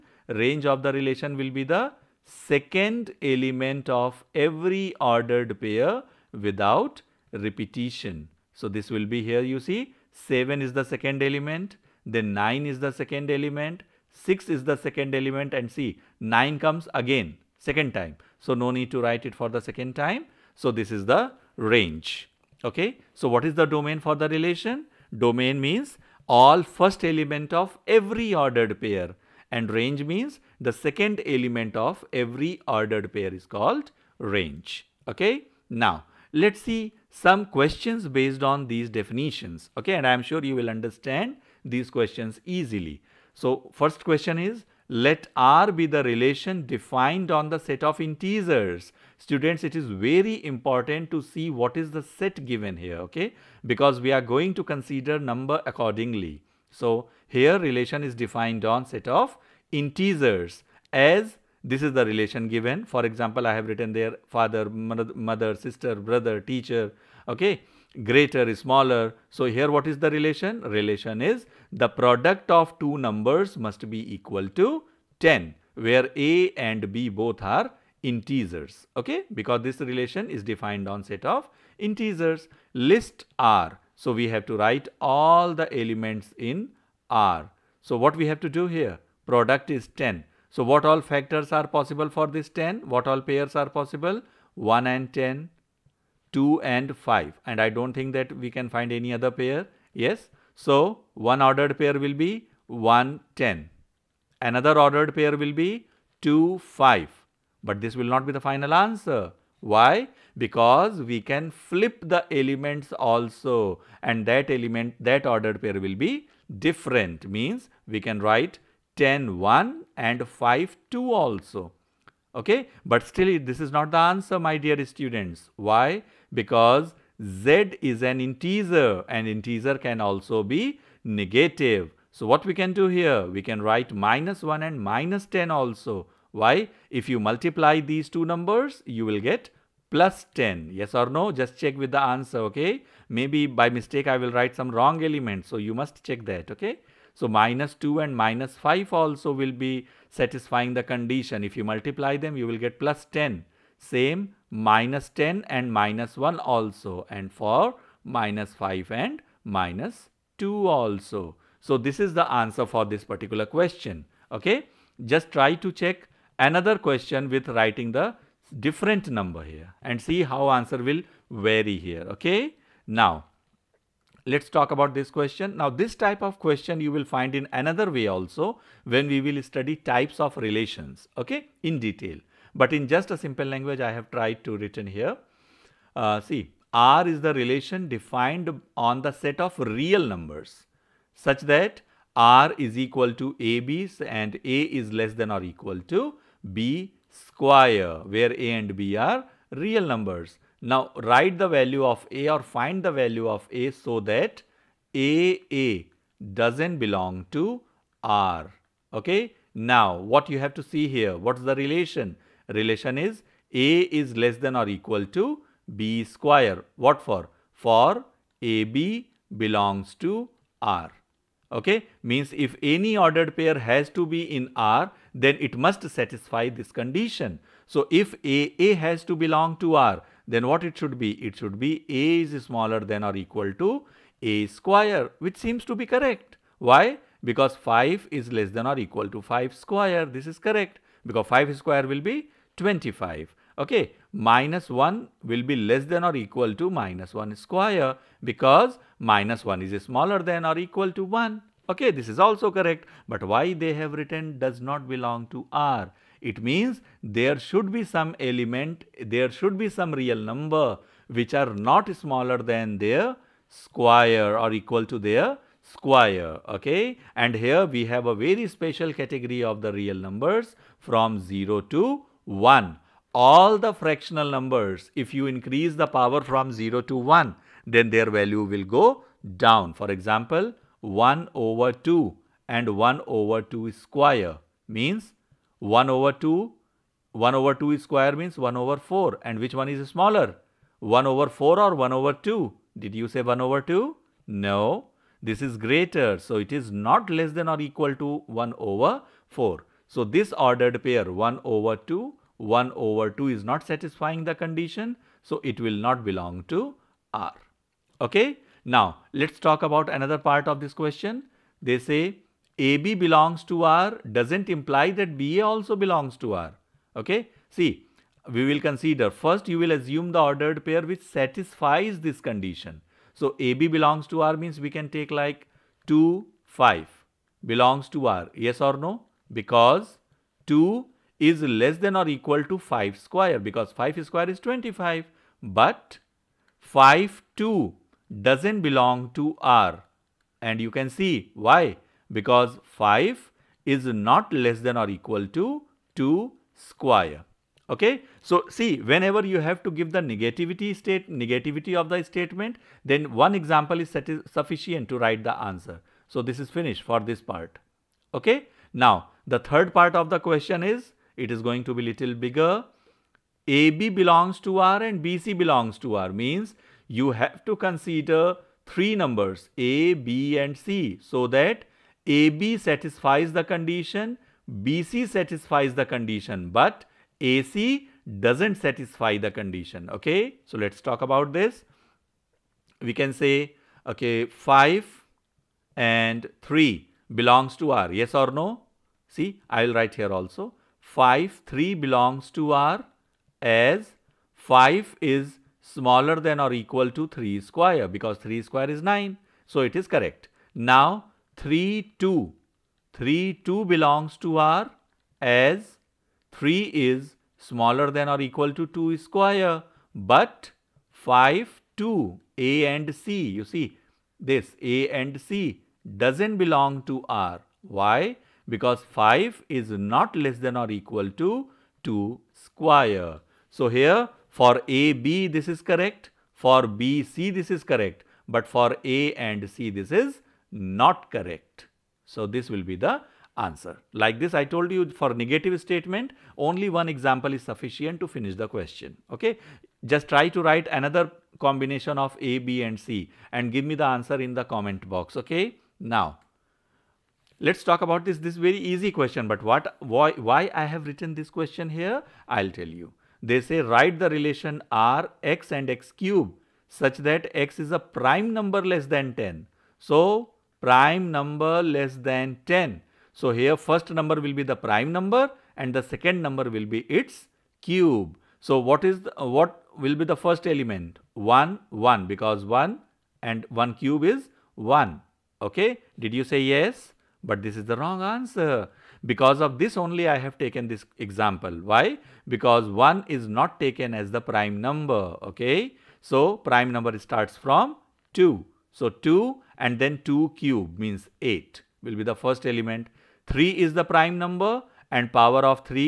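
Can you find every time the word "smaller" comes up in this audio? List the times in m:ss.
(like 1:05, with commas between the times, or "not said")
1:08, 3:52, 4:09, 4:21, 4:49, 6:35, 6:47.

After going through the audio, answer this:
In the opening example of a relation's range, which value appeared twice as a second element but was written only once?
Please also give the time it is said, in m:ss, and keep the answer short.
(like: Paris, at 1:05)
9, at 0:15.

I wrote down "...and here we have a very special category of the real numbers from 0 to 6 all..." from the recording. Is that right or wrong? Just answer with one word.
wrong.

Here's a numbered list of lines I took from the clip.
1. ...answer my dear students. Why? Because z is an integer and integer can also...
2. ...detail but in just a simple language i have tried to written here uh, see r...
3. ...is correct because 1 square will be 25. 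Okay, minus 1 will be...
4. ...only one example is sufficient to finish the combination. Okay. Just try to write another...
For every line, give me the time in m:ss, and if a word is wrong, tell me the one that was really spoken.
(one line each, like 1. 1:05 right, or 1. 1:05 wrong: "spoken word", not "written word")
1. 2:03 right
2. 3:01 right
3. 4:00 wrong: "5", not "1"
4. 7:16 wrong: "question", not "combination".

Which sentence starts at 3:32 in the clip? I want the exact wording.
Relation is a is less than or equal to b square.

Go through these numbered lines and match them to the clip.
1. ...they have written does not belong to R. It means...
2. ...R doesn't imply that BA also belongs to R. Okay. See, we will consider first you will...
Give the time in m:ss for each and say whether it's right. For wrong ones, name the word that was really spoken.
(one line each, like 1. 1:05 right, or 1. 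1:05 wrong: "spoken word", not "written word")
1. 4:13 right
2. 5:13 right.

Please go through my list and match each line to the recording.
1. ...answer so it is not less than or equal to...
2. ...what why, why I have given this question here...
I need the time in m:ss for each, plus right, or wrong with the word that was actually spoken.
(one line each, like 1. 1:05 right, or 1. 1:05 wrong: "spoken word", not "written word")
1. 4:55 wrong: "greater", not "answer"
2. 7:29 wrong: "written", not "given".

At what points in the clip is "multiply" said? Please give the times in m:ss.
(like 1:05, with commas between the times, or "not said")
2:17, 2:31.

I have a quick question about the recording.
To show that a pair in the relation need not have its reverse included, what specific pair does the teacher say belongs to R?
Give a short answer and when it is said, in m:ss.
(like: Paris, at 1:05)
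(2, 5), at 5:25.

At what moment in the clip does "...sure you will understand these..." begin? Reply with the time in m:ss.
0:40.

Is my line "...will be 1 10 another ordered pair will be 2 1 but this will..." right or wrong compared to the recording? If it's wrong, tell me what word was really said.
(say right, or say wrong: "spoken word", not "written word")
wrong: "5", not "1".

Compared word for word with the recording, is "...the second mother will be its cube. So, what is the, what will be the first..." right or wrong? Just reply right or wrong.
wrong.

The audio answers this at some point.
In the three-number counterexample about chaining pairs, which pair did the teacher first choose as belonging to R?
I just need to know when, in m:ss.
6:24.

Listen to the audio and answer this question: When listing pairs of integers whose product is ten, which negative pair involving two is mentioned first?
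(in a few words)
-2 and -5.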